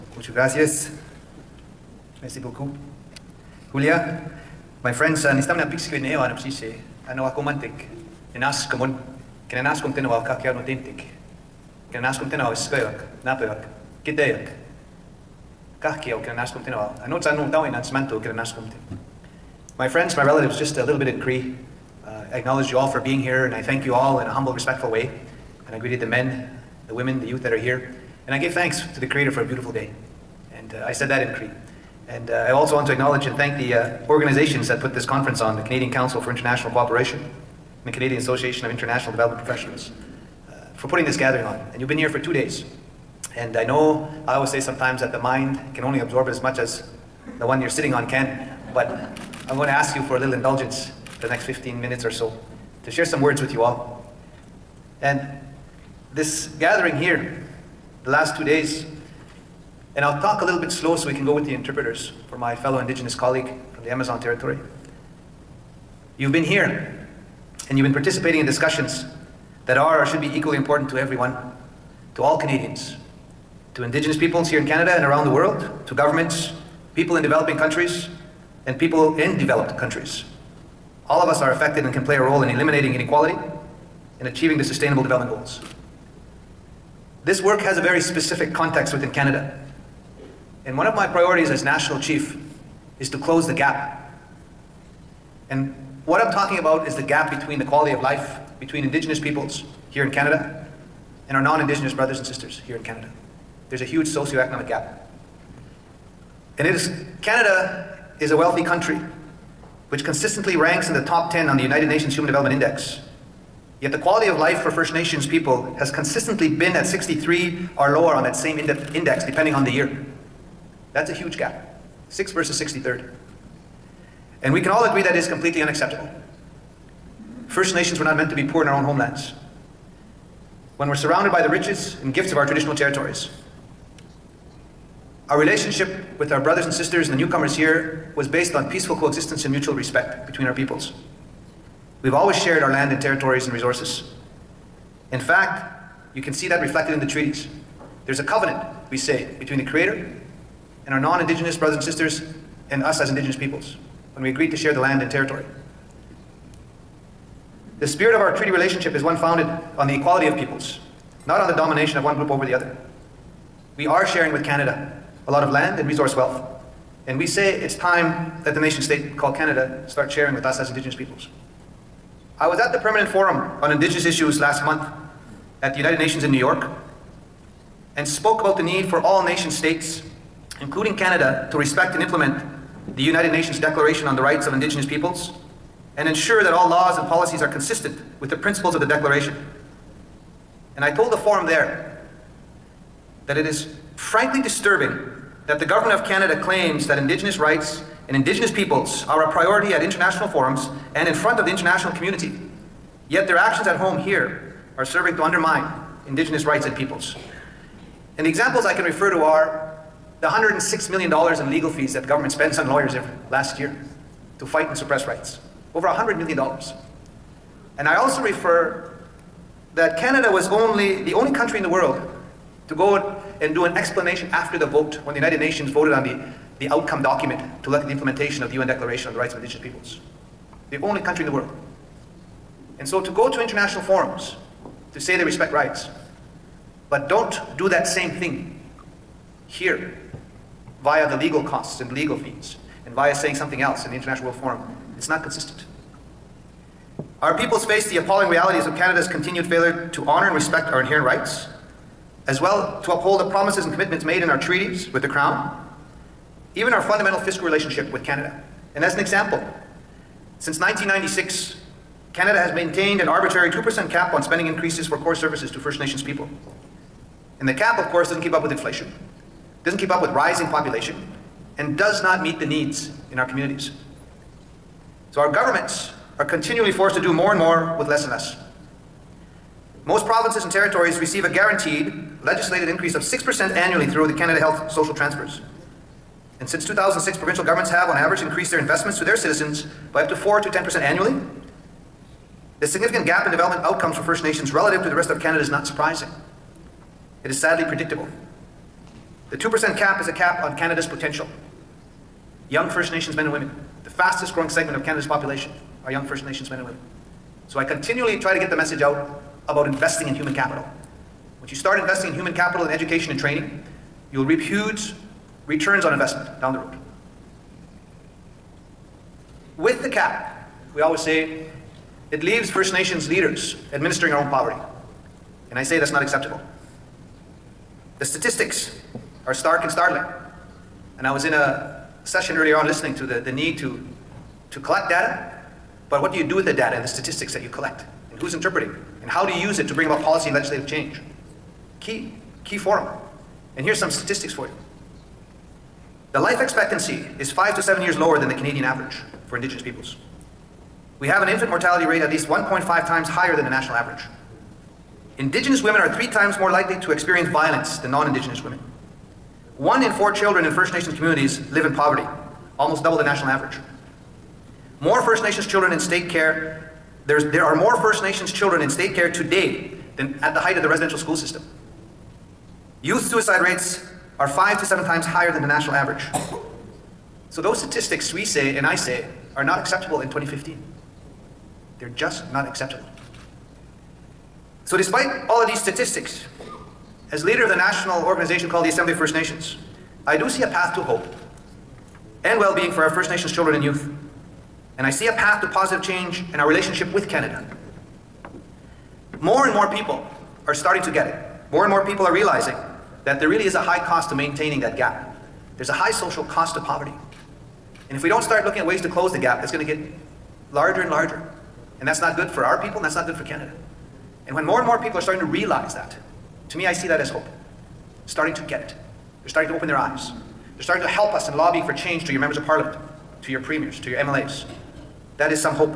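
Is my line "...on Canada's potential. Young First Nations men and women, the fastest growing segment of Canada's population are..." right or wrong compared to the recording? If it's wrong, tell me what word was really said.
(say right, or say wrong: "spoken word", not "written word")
right.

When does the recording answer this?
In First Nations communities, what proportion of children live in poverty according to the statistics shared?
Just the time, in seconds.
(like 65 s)
359 s.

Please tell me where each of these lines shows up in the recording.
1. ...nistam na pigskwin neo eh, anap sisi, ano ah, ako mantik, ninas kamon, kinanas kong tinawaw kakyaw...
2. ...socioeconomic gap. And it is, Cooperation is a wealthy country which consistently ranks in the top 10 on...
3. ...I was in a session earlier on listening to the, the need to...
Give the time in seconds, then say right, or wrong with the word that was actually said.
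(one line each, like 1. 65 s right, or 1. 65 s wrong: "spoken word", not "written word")
1. 5 s right
2. 104 s wrong: "Canada", not "Cooperation"
3. 331 s right.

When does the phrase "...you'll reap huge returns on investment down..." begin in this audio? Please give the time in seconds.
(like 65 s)
314 s.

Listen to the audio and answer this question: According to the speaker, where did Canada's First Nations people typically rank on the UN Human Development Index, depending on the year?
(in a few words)
63 or lower.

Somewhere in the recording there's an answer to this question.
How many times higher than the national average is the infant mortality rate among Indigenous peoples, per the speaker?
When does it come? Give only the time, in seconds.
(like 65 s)
352 s.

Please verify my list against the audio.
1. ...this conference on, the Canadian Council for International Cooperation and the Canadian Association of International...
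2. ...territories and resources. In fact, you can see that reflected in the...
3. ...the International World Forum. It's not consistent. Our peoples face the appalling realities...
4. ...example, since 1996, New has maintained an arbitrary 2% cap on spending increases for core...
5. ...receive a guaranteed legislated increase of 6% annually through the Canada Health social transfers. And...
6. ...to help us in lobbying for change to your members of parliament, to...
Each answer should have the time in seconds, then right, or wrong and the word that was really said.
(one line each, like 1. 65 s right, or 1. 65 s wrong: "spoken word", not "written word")
1. 34 s right
2. 142 s right
3. 243 s right
4. 258 s wrong: "Canada", not "New"
5. 280 s right
6. 420 s right.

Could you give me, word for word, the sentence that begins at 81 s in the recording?
All of us are affected and can play a role in eliminating inequality and achieving the Sustainable Development Goals.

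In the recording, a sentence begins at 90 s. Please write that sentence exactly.
And one of my priorities as national chief is to close the gap.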